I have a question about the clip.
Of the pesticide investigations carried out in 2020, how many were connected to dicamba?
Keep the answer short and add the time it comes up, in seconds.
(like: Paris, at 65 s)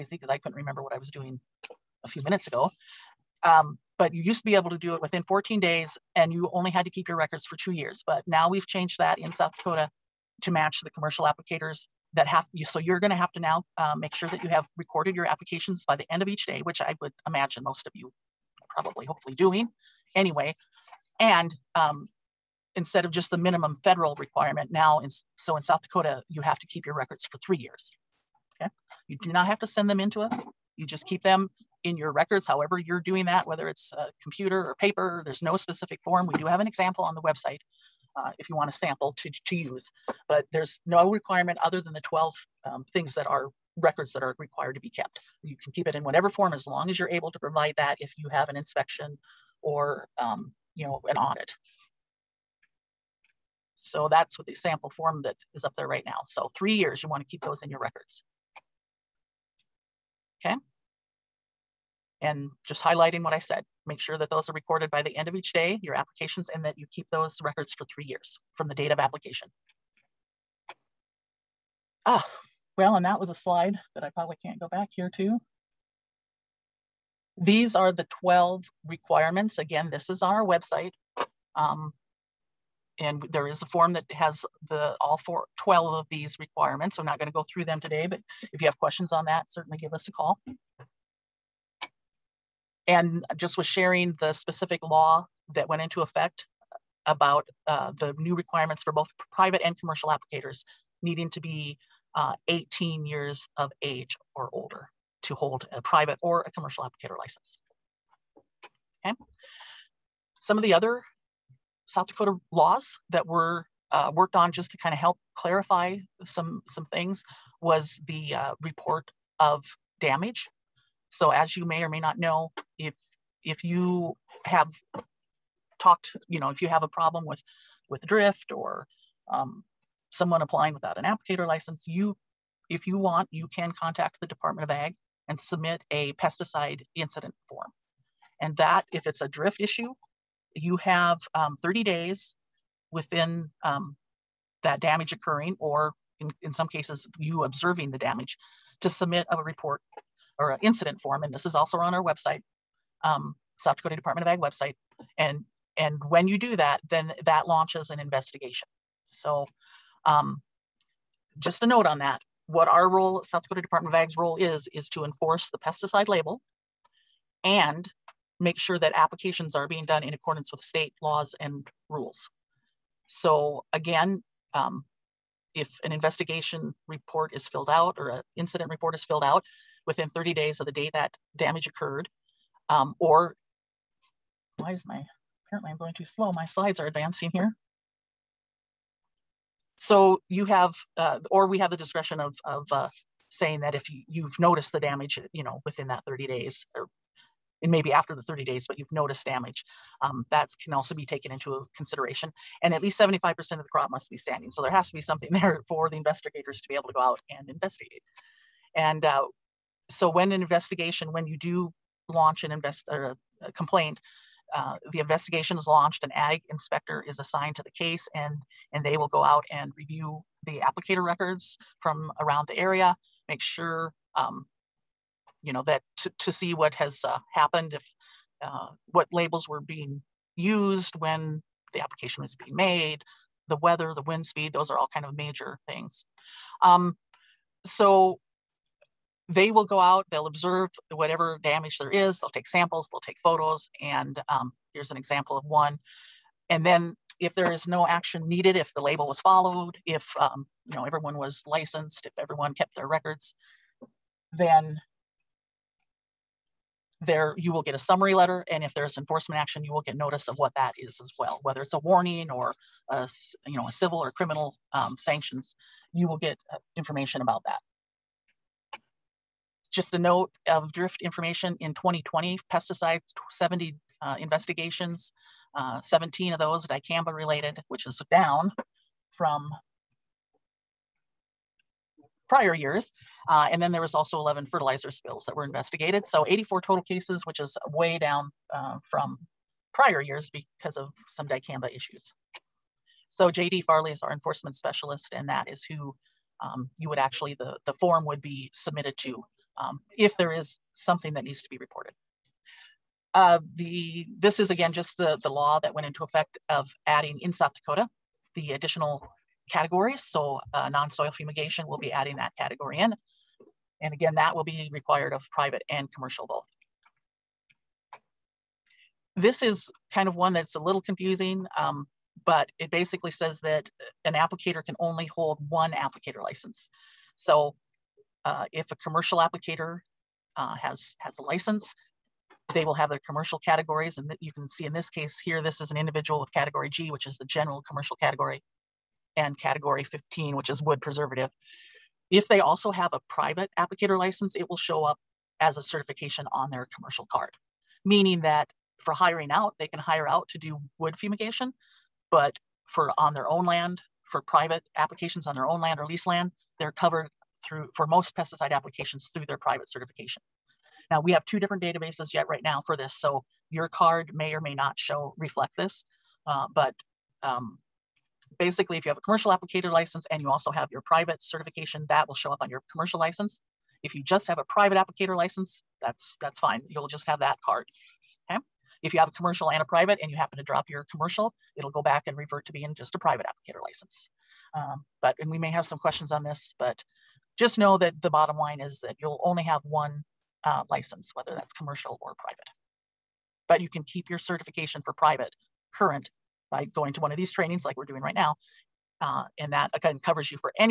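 17, at 275 s.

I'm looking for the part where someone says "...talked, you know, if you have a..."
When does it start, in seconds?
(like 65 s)
125 s.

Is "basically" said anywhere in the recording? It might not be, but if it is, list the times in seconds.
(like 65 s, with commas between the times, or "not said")
322 s, 368 s.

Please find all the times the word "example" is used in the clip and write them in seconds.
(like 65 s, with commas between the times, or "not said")
36 s, 244 s.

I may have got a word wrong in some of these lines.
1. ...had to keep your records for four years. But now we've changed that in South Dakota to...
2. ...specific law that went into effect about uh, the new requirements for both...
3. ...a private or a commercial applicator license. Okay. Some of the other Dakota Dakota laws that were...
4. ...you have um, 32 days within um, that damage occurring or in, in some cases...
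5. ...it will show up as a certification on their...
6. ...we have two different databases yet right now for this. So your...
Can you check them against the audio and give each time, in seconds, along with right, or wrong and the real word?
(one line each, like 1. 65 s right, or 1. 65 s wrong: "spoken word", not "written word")
1. 6 s wrong: "two", not "four"
2. 94 s right
3. 105 s wrong: "South", not "Dakota"
4. 140 s wrong: "30", not "32"
5. 344 s right
6. 361 s right.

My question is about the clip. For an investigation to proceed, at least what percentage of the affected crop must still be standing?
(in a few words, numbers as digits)
75%.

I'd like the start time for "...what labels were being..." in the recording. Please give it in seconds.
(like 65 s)
228 s.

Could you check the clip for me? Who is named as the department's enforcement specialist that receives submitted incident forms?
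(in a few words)
JD Farley.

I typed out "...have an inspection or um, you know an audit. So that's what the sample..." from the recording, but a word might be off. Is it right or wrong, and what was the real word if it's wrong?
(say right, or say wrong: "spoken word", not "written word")
right.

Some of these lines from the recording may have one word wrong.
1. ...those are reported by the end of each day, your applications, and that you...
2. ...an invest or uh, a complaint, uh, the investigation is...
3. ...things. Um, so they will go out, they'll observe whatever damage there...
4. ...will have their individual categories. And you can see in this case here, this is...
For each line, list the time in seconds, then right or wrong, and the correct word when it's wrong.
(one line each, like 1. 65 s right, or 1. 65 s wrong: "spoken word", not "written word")
1. 64 s wrong: "recorded", not "reported"
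2. 212 s right
3. 235 s right
4. 332 s wrong: "commercial", not "individual".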